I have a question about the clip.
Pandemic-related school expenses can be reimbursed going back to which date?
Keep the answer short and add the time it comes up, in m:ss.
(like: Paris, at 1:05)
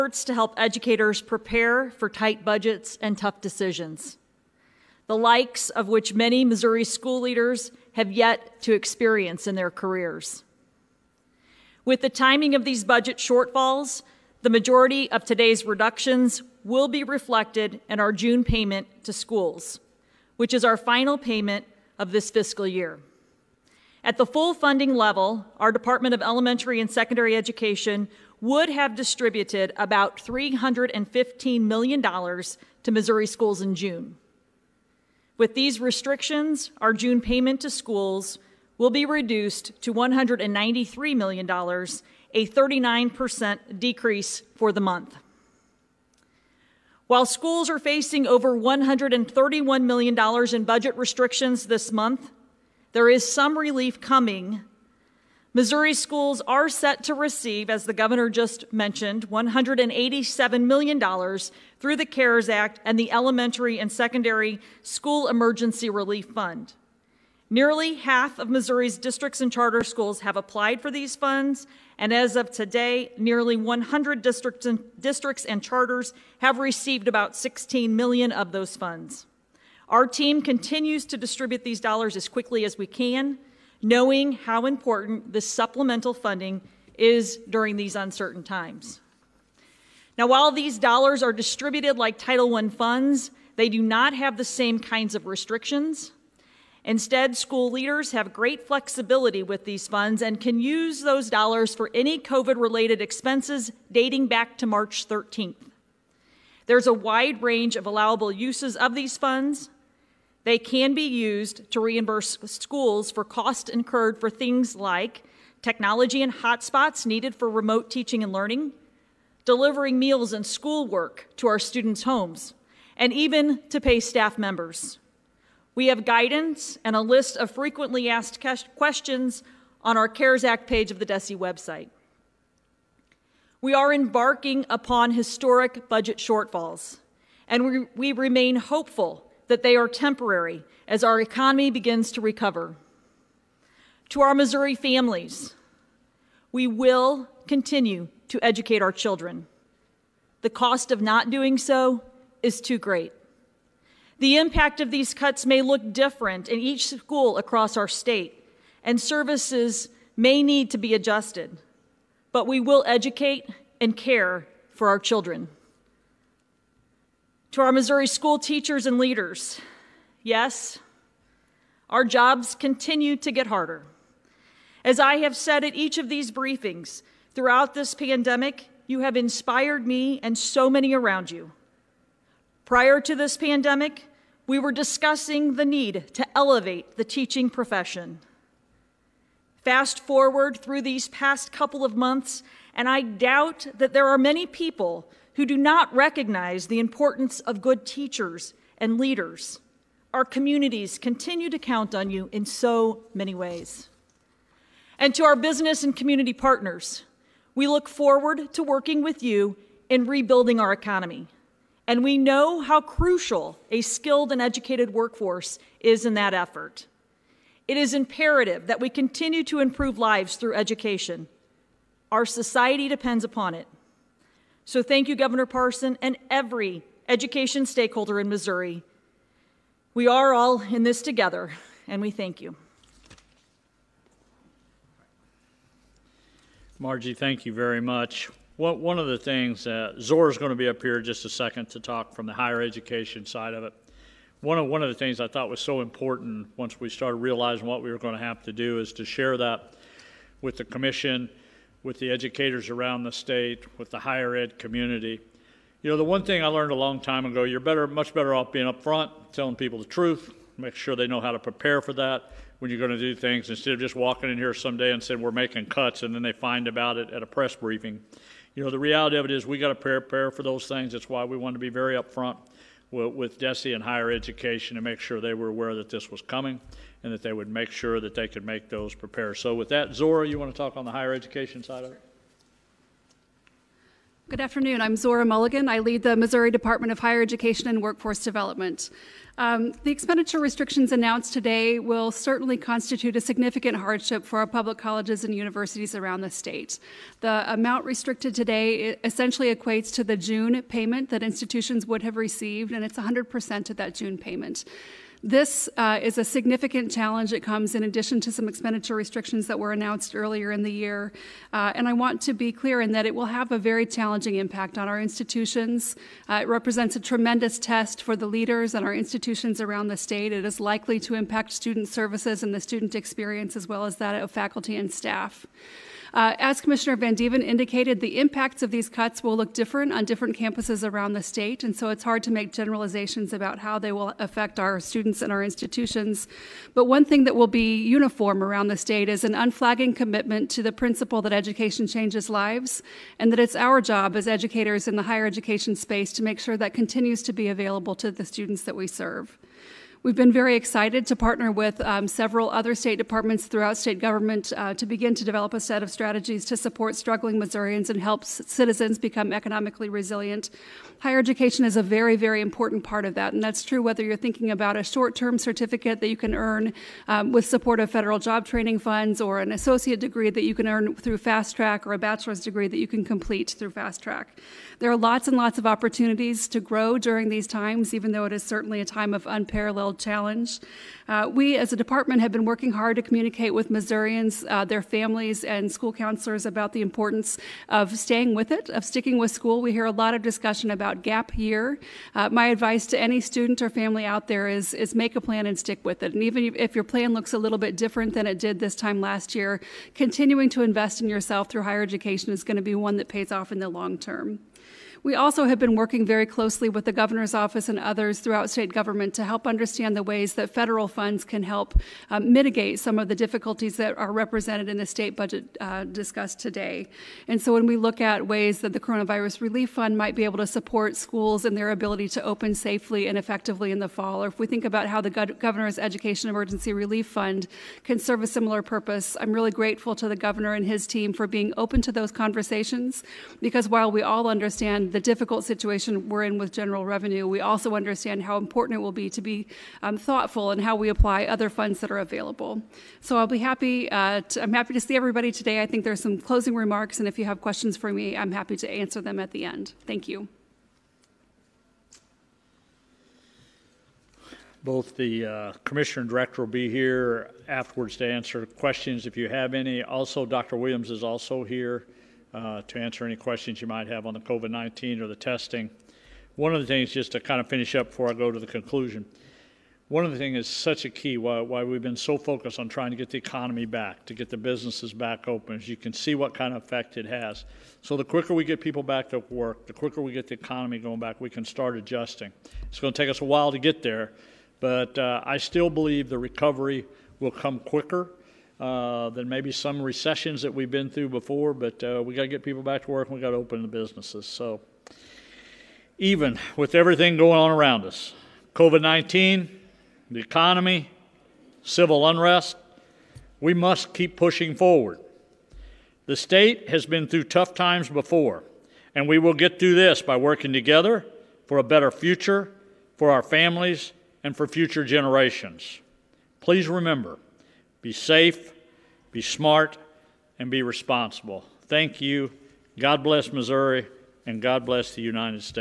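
March 13th, at 1:44.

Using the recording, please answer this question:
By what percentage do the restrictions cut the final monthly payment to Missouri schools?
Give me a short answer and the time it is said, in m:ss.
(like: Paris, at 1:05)
39%, at 0:42.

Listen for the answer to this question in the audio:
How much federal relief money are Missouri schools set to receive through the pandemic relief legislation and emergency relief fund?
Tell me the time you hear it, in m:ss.
0:59.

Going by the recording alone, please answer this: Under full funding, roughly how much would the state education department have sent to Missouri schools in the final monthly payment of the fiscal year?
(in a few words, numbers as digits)
$315 million.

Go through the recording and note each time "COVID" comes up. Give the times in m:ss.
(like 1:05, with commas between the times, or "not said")
1:42, 7:44, 8:18.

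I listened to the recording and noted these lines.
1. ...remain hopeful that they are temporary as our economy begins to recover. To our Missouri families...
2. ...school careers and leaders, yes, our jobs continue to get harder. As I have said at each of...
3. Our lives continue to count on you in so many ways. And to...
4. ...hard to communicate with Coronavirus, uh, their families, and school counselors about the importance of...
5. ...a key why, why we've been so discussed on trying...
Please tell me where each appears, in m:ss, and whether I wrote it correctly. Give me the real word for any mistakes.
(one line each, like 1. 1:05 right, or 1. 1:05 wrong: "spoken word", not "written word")
1. 2:18 right
2. 2:48 wrong: "teachers", not "careers"
3. 3:20 wrong: "communities", not "lives"
4. 6:22 wrong: "Missourians", not "Coronavirus"
5. 7:50 wrong: "focused", not "discussed".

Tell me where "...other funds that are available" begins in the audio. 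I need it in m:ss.
7:21.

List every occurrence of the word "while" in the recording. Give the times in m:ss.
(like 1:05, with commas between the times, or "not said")
0:47, 1:30, 7:13, 8:03.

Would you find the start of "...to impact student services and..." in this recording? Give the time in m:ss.
5:20.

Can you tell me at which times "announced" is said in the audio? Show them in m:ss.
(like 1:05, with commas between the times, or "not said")
4:50, 5:09.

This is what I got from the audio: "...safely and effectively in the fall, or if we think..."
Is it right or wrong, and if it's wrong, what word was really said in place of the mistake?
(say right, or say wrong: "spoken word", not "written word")
right.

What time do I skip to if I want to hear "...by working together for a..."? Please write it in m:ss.
8:30.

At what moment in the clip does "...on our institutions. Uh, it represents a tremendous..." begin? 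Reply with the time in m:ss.
5:14.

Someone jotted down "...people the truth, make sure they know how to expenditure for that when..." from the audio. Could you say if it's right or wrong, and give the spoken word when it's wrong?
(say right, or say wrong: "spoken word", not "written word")
wrong: "prepare", not "expenditure".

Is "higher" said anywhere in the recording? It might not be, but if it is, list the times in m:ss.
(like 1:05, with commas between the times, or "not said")
4:02, 4:13, 4:33, 4:40, 4:46, 5:45, 6:00, 6:41.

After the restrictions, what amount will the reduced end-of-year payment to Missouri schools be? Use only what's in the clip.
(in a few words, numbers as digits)
$193 million.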